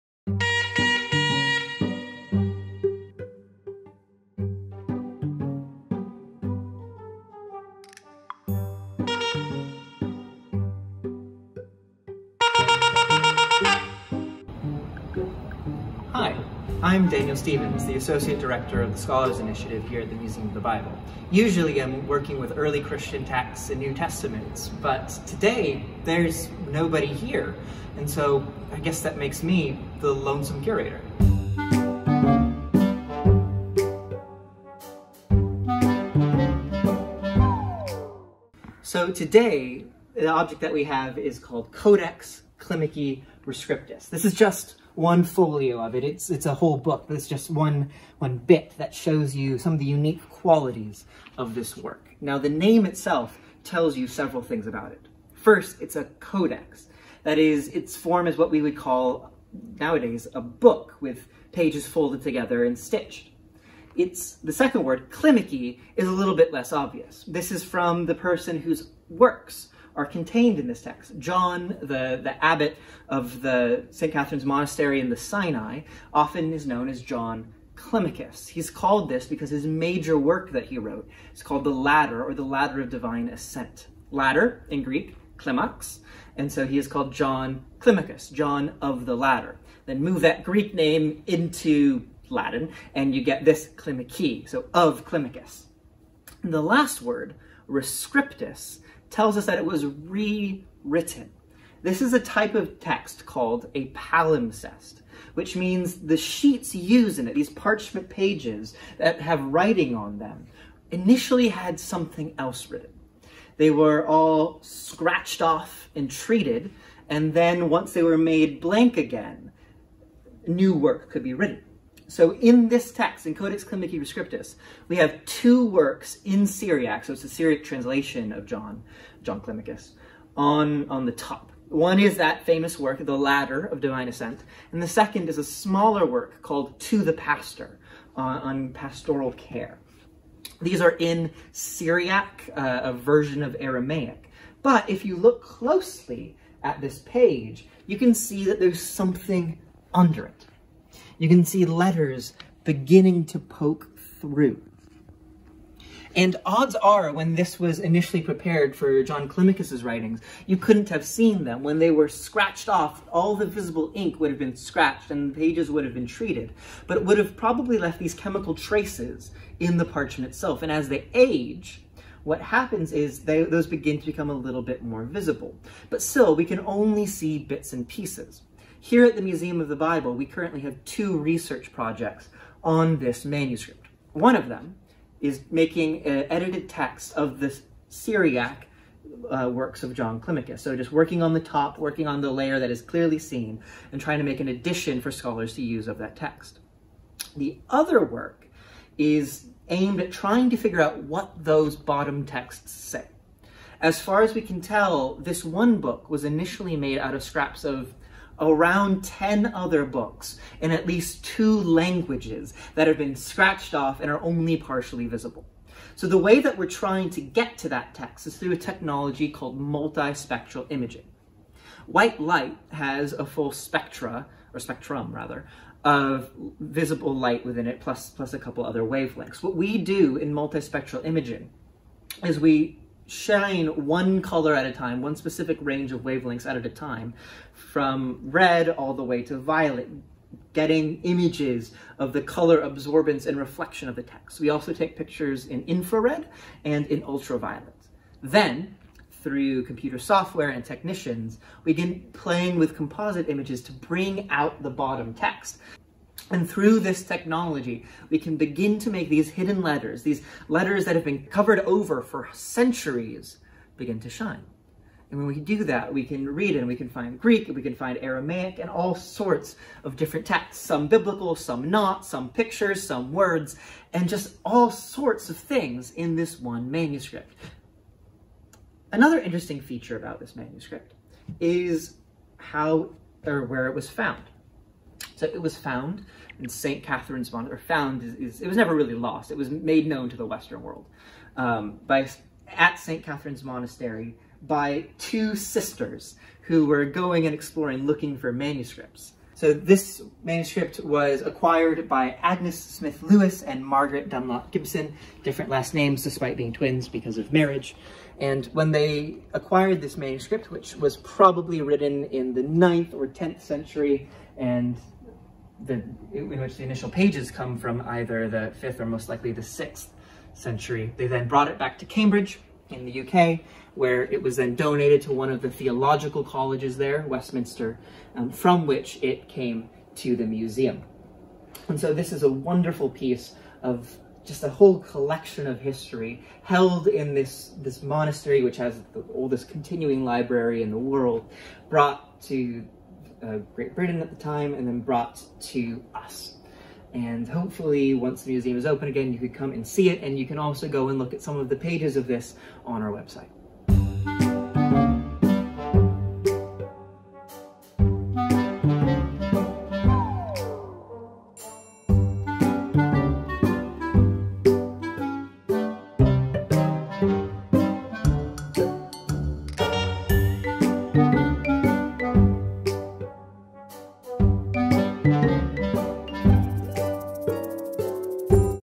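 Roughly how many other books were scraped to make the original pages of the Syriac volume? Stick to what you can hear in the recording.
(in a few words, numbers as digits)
10.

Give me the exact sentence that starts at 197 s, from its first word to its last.
The other work is aimed at trying to figure out what those bottom texts say.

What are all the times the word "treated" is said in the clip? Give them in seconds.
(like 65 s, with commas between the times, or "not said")
116 s, 166 s.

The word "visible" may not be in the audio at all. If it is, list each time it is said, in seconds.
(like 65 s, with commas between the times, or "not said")
163 s, 175 s, 215 s, 226 s.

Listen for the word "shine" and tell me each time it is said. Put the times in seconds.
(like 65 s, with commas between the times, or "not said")
233 s, 264 s.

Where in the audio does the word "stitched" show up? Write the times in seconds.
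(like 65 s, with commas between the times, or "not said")
62 s.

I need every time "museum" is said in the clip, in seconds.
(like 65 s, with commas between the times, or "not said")
20 s, 179 s, 330 s, 348 s.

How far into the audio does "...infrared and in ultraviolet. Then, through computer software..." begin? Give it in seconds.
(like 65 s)
245 s.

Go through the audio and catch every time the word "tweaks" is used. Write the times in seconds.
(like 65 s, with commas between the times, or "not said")
not said.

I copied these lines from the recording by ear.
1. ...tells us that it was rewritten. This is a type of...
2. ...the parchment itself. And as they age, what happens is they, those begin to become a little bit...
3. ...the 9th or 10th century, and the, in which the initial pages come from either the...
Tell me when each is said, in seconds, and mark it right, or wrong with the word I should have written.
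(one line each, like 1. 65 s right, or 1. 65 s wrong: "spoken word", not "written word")
1. 99 s right
2. 169 s right
3. 312 s right.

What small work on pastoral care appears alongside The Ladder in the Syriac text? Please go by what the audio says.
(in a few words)
To the Pastor.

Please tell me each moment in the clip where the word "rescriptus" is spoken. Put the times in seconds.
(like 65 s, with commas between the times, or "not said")
43 s, 97 s, 123 s.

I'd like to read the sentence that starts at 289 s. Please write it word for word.
It was made known to the Western world um, by at St.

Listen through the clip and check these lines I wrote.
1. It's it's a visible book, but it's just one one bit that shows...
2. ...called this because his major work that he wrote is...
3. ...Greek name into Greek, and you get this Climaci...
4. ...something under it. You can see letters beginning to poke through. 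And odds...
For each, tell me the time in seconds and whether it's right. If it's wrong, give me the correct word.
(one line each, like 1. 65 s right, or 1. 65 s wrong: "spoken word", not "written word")
1. 46 s wrong: "whole", not "visible"
2. 78 s right
3. 90 s wrong: "Latin", not "Greek"
4. 148 s right.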